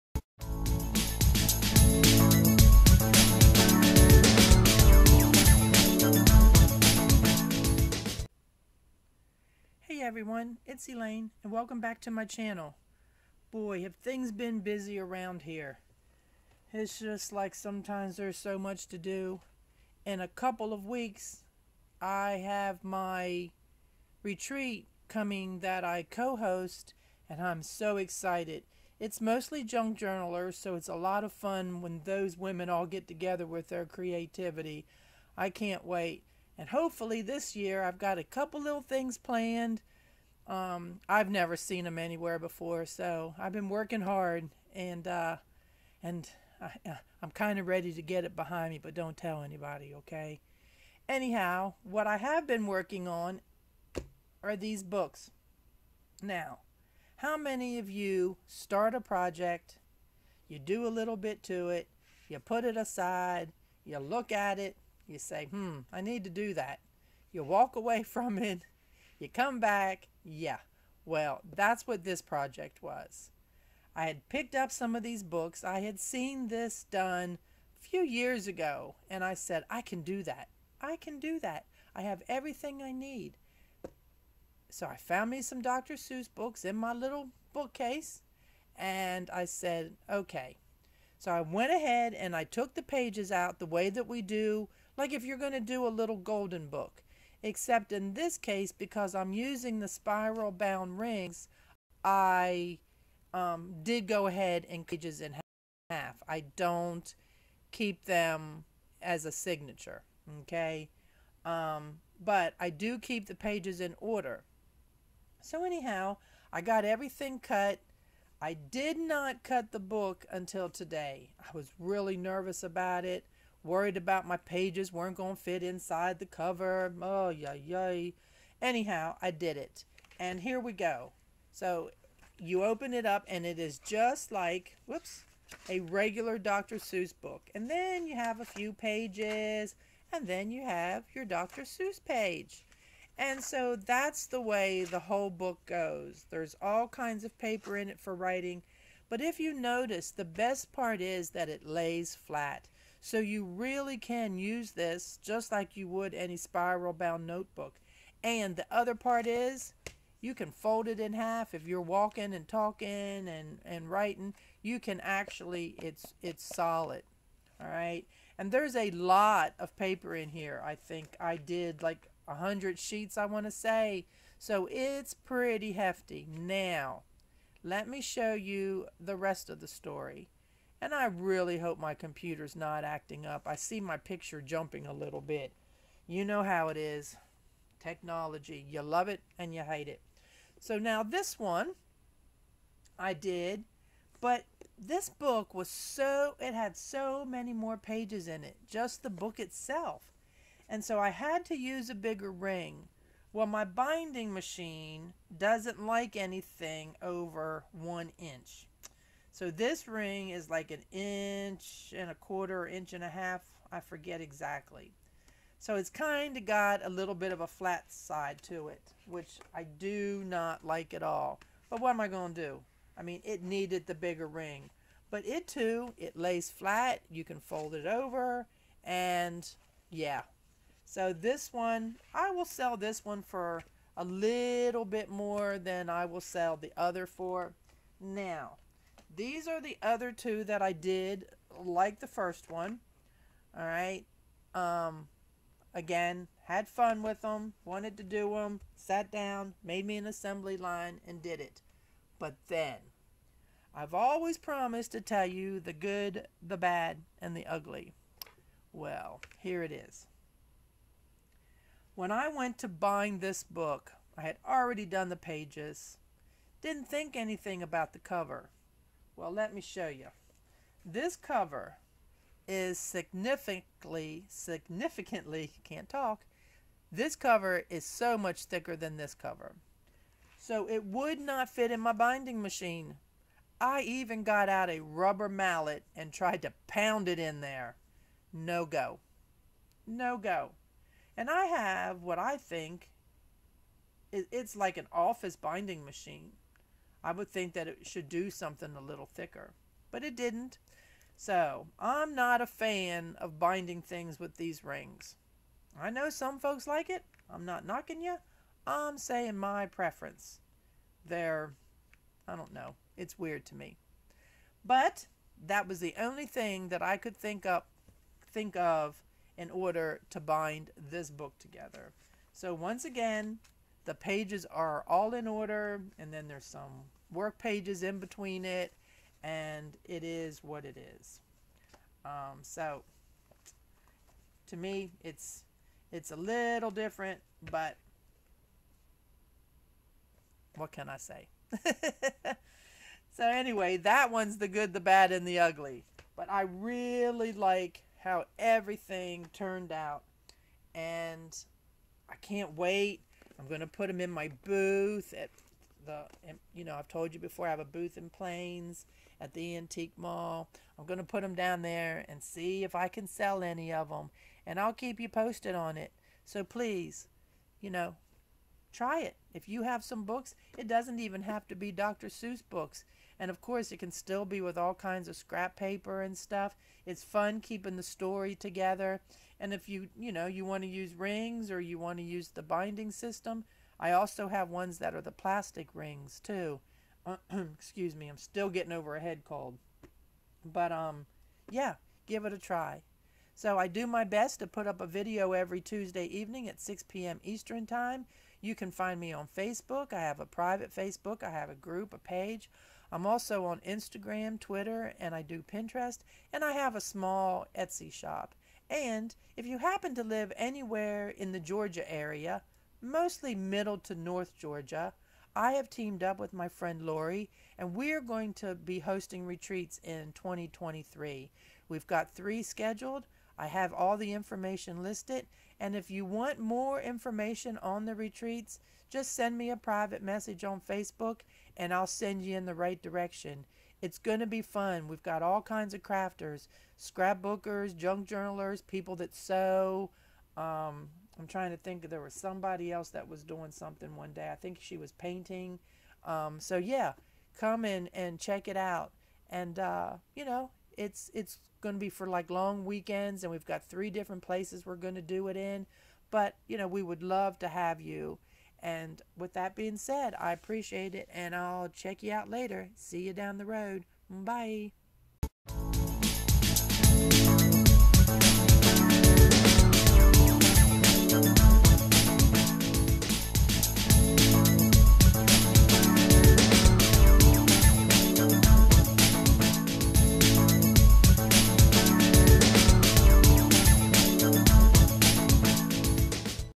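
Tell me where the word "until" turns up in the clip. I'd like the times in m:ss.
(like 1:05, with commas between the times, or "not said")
2:00.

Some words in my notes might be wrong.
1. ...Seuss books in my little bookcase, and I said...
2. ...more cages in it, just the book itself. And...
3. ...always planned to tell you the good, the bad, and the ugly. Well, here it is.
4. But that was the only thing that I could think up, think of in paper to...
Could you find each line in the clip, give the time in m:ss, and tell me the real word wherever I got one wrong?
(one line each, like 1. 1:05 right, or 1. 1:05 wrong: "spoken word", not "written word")
1. 1:25 right
2. 3:17 wrong: "pages", not "cages"
3. 4:13 wrong: "promised", not "planned"
4. 5:14 wrong: "order", not "paper".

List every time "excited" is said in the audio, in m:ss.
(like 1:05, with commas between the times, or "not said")
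0:27.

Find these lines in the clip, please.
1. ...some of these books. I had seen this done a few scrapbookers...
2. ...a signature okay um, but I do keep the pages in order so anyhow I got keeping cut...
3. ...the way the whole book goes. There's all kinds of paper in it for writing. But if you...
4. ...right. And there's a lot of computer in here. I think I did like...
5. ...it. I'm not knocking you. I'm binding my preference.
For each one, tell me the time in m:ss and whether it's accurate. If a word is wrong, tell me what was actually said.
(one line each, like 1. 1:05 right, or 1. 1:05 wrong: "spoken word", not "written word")
1. 1:14 wrong: "years", not "scrapbookers"
2. 1:49 wrong: "everything", not "keeping"
3. 2:24 right
4. 2:47 wrong: "paper", not "computer"
5. 5:06 wrong: "saying", not "binding".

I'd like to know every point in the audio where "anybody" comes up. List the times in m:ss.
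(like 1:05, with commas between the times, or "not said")
0:49.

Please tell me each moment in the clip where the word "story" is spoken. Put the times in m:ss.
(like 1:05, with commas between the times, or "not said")
2:59, 6:17.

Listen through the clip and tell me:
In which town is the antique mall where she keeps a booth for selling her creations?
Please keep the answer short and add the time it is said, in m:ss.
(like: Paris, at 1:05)
Plains, at 5:58.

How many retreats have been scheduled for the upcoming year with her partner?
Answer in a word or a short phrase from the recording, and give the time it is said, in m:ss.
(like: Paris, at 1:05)
3, at 7:02.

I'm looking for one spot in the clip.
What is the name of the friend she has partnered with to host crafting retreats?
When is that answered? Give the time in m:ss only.
6:56.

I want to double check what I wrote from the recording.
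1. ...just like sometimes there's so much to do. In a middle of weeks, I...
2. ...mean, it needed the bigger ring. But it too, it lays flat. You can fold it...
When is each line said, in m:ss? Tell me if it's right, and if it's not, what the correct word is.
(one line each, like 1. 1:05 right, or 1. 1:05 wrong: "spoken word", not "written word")
1. 0:16 wrong: "couple", not "middle"
2. 3:43 right.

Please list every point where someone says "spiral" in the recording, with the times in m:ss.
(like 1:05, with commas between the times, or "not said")
1:39, 2:36.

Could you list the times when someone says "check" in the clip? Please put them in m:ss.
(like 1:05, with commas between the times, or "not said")
7:28, 7:41.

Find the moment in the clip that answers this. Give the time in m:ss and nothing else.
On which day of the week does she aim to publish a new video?
6:35.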